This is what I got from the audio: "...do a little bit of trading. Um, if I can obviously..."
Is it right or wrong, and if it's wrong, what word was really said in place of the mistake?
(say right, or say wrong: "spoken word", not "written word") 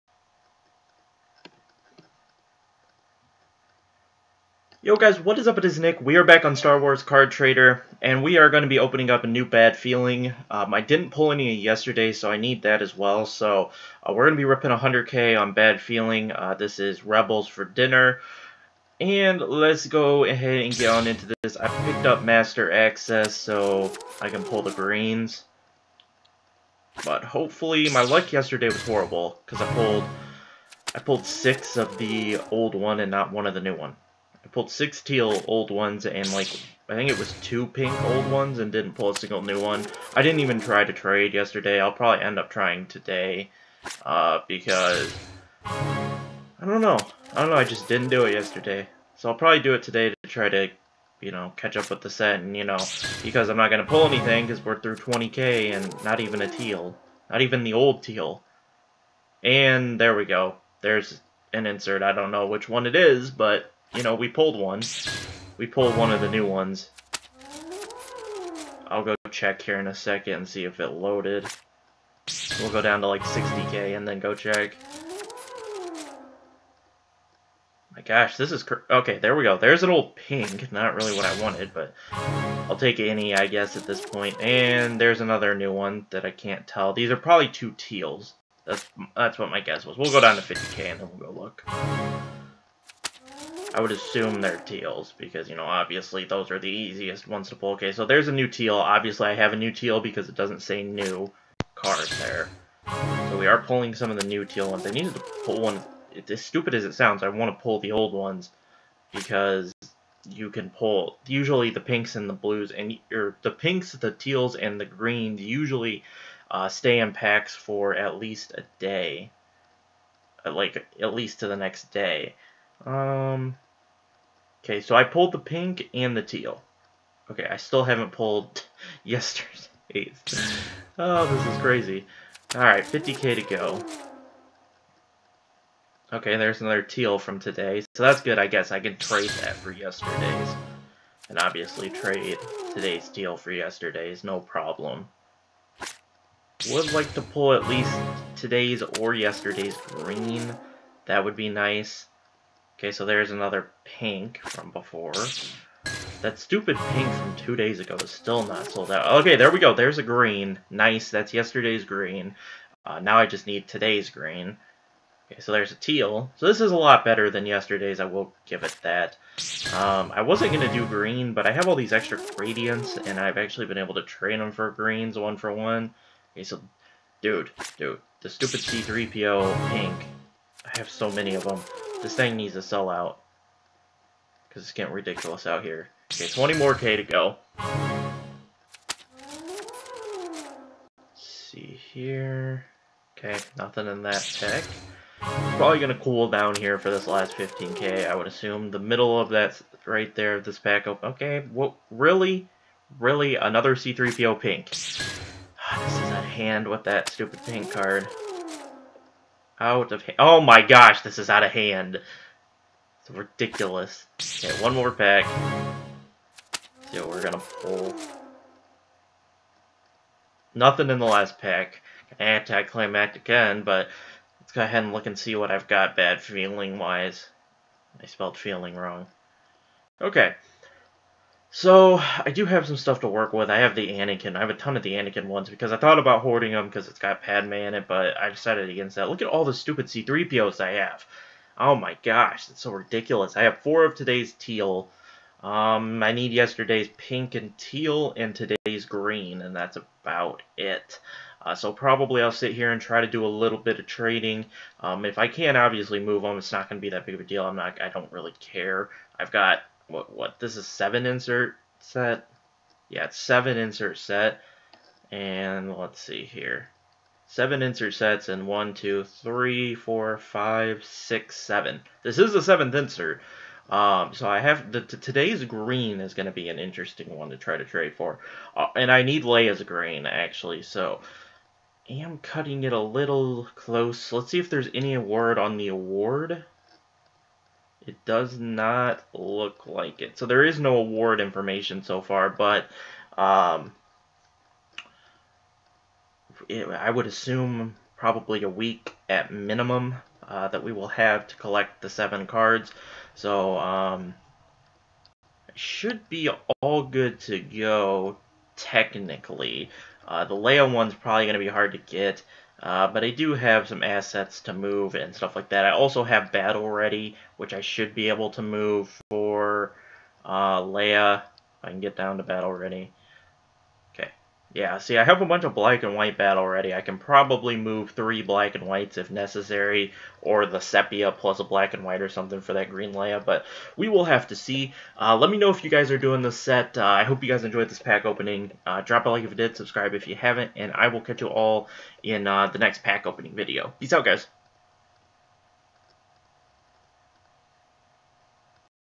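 right.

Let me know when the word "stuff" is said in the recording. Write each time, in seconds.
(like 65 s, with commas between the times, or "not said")
232 s, 315 s.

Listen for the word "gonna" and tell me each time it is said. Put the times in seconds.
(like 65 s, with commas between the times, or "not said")
53 s, 217 s.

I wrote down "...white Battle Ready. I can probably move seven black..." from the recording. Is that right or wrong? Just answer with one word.
wrong.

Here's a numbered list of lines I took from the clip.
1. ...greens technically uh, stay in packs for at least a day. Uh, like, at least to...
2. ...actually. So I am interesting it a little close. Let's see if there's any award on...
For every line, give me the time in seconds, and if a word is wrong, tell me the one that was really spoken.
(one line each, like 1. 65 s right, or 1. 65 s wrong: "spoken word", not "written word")
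1. 114 s wrong: "usually", not "technically"
2. 280 s wrong: "cutting", not "interesting".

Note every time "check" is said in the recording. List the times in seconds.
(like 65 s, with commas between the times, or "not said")
69 s, 74 s.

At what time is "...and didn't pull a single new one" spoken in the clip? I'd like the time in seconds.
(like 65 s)
38 s.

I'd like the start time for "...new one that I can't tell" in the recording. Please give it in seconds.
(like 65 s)
85 s.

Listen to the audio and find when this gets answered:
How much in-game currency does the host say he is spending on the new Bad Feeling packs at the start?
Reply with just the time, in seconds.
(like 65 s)
14 s.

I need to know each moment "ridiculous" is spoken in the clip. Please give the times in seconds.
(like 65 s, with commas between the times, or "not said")
184 s, 213 s, 242 s.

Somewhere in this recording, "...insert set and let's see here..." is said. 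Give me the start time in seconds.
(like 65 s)
263 s.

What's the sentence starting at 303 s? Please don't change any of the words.
So um, should be all good to go technically.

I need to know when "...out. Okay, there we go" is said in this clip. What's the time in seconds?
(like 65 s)
158 s.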